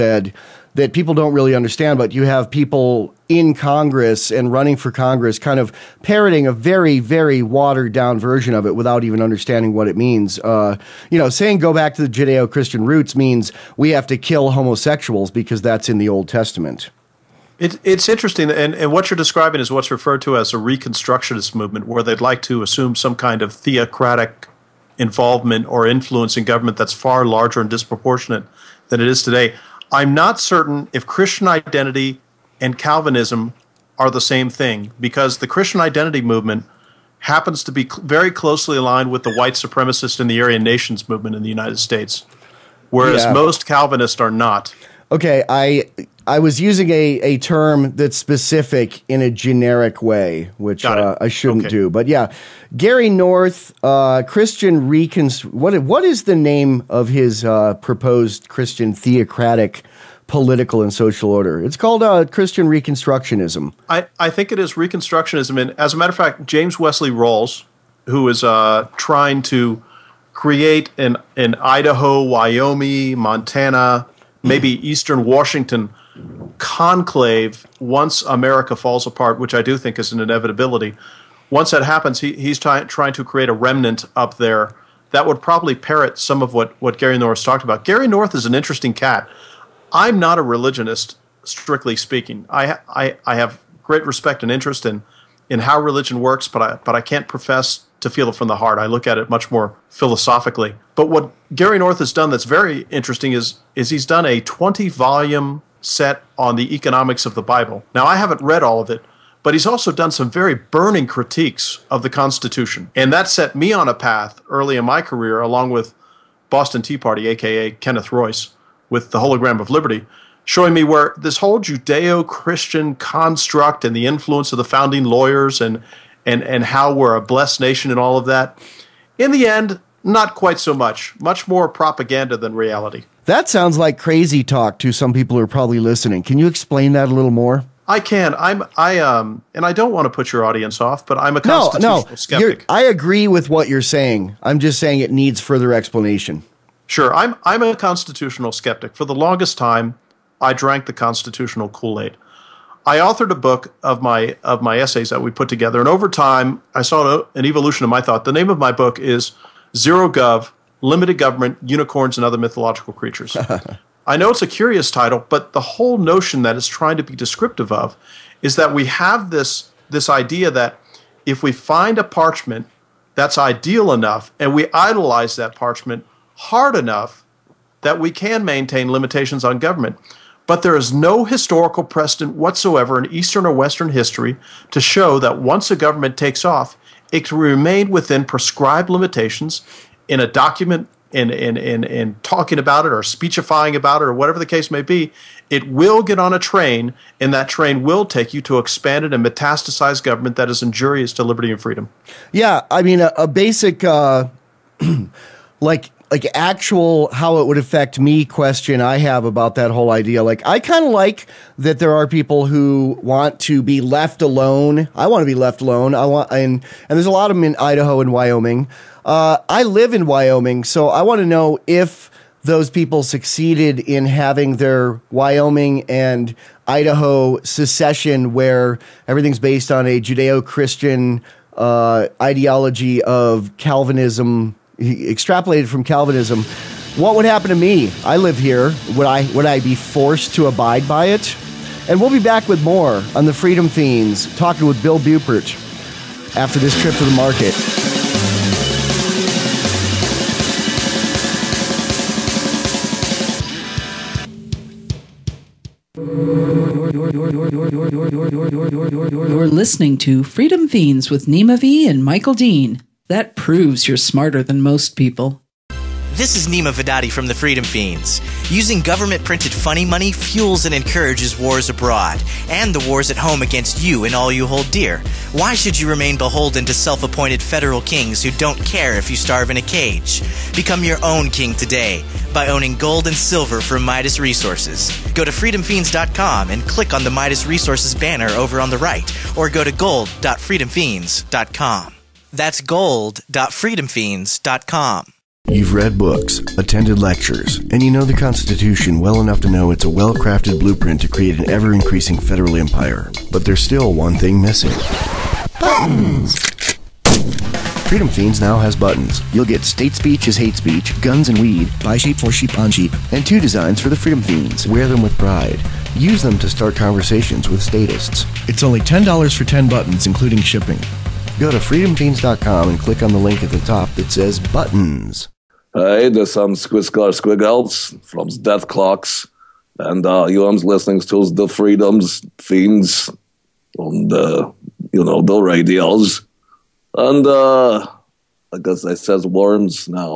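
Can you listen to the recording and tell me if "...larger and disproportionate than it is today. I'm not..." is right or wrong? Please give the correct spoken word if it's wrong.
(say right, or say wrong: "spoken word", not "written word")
right.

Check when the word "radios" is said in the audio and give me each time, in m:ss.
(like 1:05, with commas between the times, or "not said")
5:35.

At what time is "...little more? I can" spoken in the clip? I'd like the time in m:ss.
2:17.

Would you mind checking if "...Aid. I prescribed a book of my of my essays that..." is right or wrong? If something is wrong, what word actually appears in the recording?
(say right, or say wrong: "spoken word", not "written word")
wrong: "authored", not "prescribed".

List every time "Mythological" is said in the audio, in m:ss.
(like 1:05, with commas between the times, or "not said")
2:42.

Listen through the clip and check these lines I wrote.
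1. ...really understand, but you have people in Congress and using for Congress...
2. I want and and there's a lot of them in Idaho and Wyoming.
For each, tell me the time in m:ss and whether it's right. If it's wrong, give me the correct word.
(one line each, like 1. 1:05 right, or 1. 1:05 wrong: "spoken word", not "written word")
1. 0:01 wrong: "running", not "using"
2. 3:35 right.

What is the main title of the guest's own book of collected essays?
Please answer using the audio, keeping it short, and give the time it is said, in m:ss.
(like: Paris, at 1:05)
Zero Gov, at 2:39.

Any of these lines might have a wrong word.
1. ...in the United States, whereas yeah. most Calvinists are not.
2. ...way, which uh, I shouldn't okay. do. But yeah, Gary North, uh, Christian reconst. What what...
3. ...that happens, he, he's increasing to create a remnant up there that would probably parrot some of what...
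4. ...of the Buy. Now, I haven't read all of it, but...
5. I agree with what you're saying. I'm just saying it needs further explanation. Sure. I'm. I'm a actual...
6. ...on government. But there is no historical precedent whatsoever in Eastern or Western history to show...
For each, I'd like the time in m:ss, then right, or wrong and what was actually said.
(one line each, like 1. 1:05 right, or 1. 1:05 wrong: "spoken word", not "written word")
1. 0:41 right
2. 0:50 right
3. 1:21 wrong: "trying", not "increasing"
4. 1:47 wrong: "Bible", not "Buy"
5. 2:22 wrong: "constitutional", not "actual"
6. 2:59 right.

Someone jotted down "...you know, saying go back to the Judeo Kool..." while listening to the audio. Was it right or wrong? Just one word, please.
wrong.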